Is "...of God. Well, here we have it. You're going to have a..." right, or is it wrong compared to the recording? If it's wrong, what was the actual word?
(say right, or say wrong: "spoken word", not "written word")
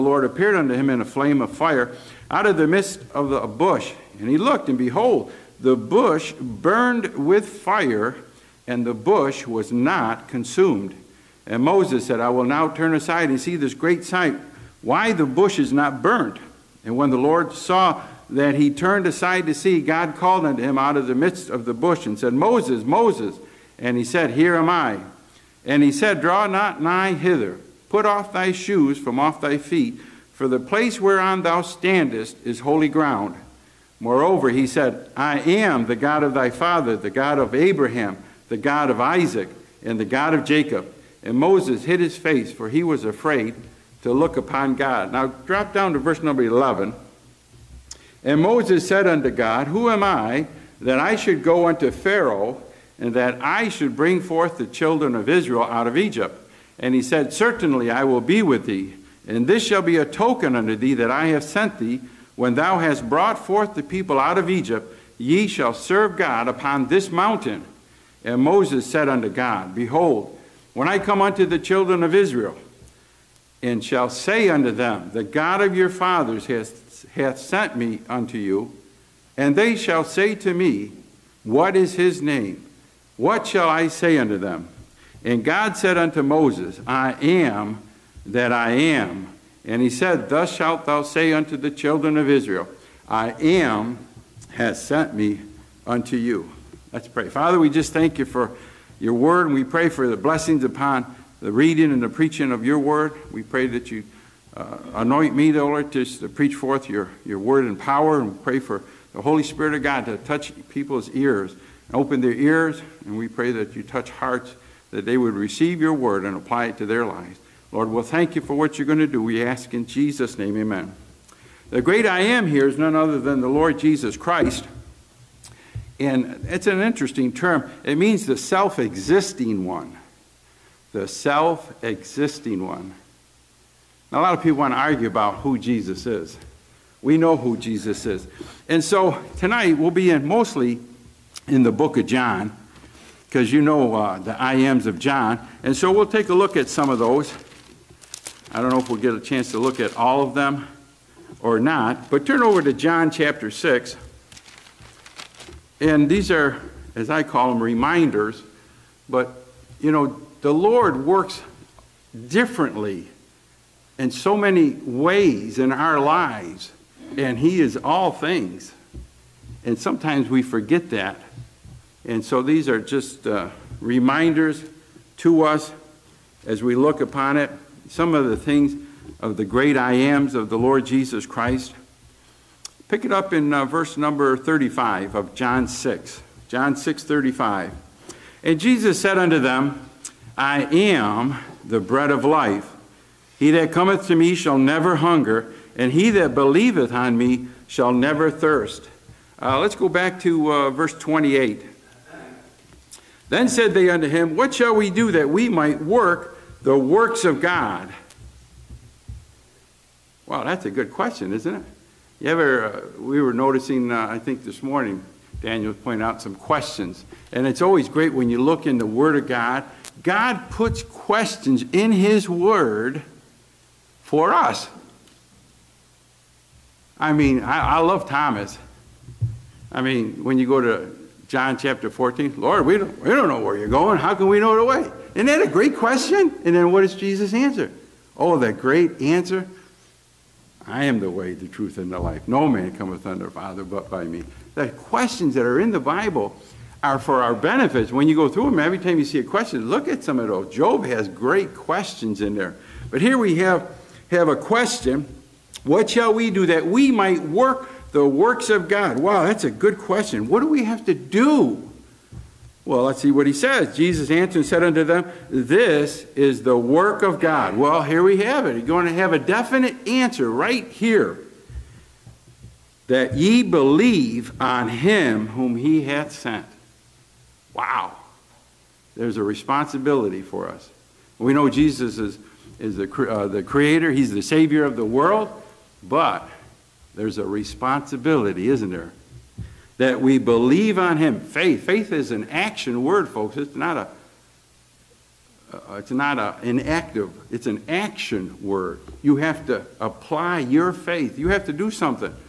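right.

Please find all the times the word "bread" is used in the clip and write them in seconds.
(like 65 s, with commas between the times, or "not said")
191 s.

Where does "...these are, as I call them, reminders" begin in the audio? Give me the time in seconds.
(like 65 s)
156 s.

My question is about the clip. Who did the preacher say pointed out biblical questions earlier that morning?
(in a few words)
Daniel.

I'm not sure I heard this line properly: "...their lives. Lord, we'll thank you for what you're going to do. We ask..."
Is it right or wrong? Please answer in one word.
right.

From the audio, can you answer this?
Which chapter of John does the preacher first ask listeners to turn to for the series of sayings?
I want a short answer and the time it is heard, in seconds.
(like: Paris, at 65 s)
6, at 152 s.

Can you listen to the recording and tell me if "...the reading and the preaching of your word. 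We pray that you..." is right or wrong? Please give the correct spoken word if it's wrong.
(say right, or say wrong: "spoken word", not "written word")
right.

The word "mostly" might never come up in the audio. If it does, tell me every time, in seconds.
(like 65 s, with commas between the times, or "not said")
140 s.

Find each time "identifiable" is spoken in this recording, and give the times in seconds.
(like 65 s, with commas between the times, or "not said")
not said.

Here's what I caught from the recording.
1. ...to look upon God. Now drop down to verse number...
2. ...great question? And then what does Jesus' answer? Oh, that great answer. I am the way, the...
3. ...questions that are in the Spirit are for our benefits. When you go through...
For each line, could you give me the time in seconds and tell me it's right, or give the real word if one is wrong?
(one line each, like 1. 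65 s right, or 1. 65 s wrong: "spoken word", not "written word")
1. 44 s right
2. 235 s right
3. 244 s wrong: "Bible", not "Spirit".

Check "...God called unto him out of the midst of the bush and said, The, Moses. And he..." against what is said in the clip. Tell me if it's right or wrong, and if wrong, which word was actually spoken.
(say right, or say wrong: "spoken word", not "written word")
wrong: "Moses", not "The".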